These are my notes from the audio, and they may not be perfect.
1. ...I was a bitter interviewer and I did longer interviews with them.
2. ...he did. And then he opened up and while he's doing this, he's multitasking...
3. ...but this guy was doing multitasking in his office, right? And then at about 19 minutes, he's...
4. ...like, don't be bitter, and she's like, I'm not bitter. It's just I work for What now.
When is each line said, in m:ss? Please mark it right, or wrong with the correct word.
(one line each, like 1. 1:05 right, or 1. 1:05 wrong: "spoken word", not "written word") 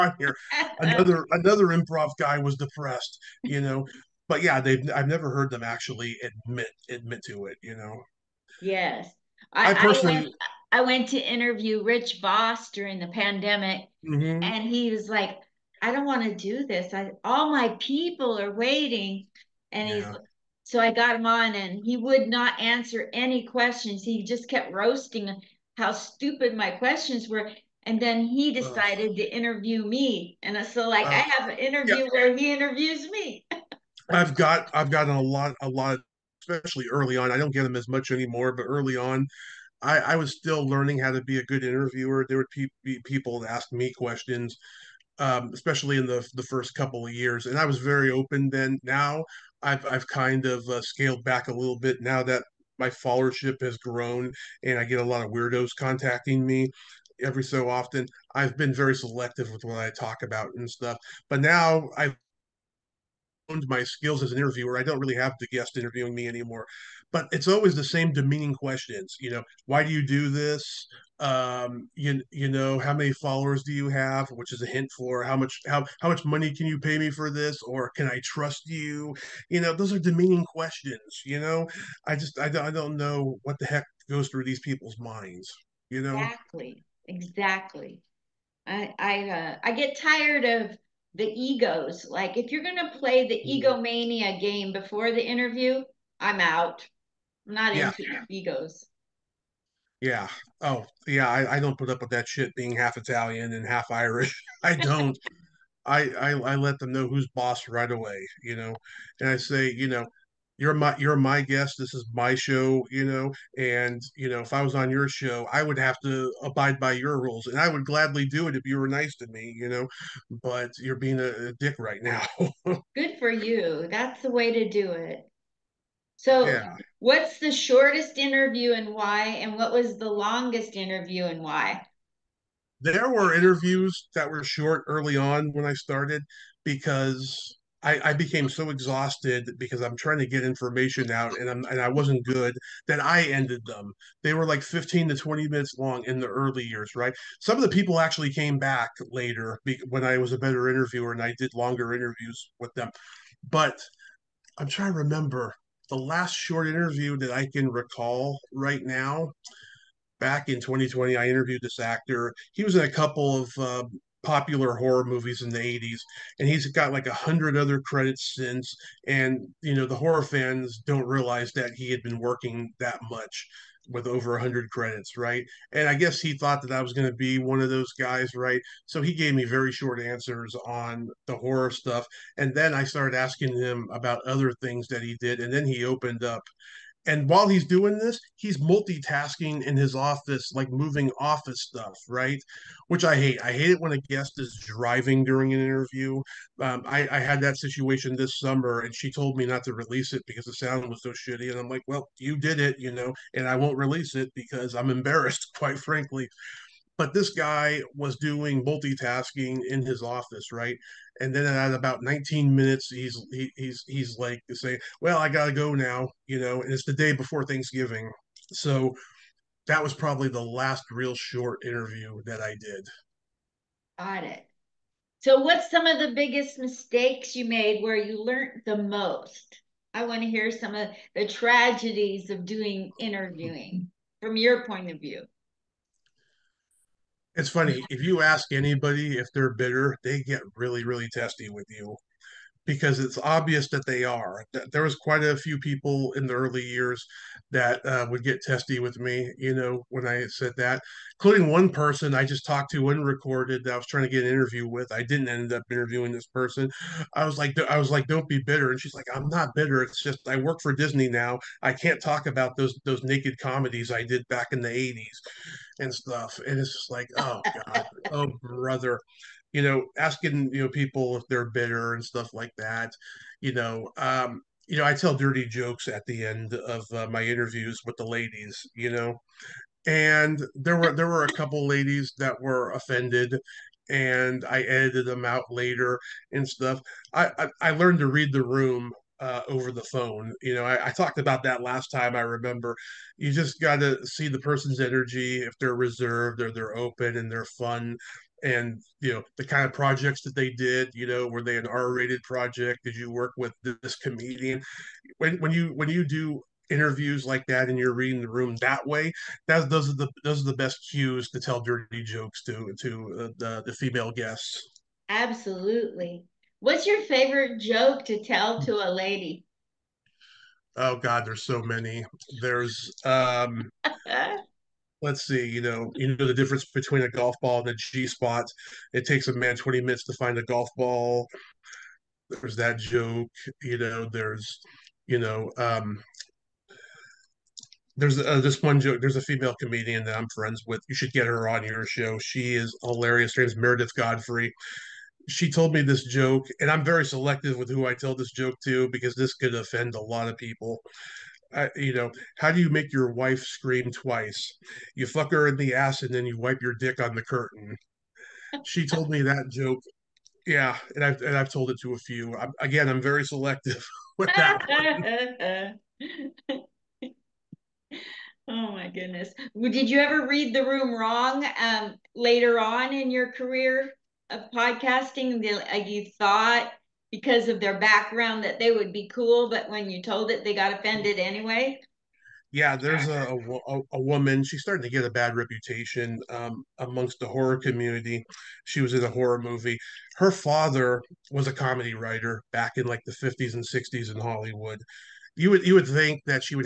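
1. 2:30 wrong: "better", not "bitter"
2. 3:05 right
3. 3:26 right
4. 4:17 wrong: "Disney", not "What".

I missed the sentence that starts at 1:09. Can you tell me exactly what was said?
You know, why do you do this?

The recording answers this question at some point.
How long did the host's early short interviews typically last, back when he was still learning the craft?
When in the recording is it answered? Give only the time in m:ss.
2:24.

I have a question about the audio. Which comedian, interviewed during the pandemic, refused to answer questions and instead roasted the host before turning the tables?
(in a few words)
Rich Voss.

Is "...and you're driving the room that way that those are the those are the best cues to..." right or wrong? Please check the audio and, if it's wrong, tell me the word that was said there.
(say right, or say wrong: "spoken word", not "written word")
wrong: "reading", not "driving".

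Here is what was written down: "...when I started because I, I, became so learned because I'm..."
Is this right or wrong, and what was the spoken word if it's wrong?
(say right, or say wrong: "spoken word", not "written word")
wrong: "exhausted", not "learned".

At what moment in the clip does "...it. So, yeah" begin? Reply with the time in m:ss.
2:04.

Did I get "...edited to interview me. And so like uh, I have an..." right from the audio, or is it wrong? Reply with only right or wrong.
wrong.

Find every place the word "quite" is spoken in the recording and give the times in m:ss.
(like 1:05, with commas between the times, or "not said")
3:25, 4:04.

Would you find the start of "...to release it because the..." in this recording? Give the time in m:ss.
3:19.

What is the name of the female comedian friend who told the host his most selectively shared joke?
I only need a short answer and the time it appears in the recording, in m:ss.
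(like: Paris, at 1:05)
Meredith Godfrey, at 5:43.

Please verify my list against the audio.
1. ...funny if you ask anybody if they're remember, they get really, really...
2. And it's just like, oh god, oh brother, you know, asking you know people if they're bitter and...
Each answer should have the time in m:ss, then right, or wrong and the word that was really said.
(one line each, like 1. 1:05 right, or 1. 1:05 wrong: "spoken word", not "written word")
1. 3:57 wrong: "bitter", not "remember"
2. 4:26 right.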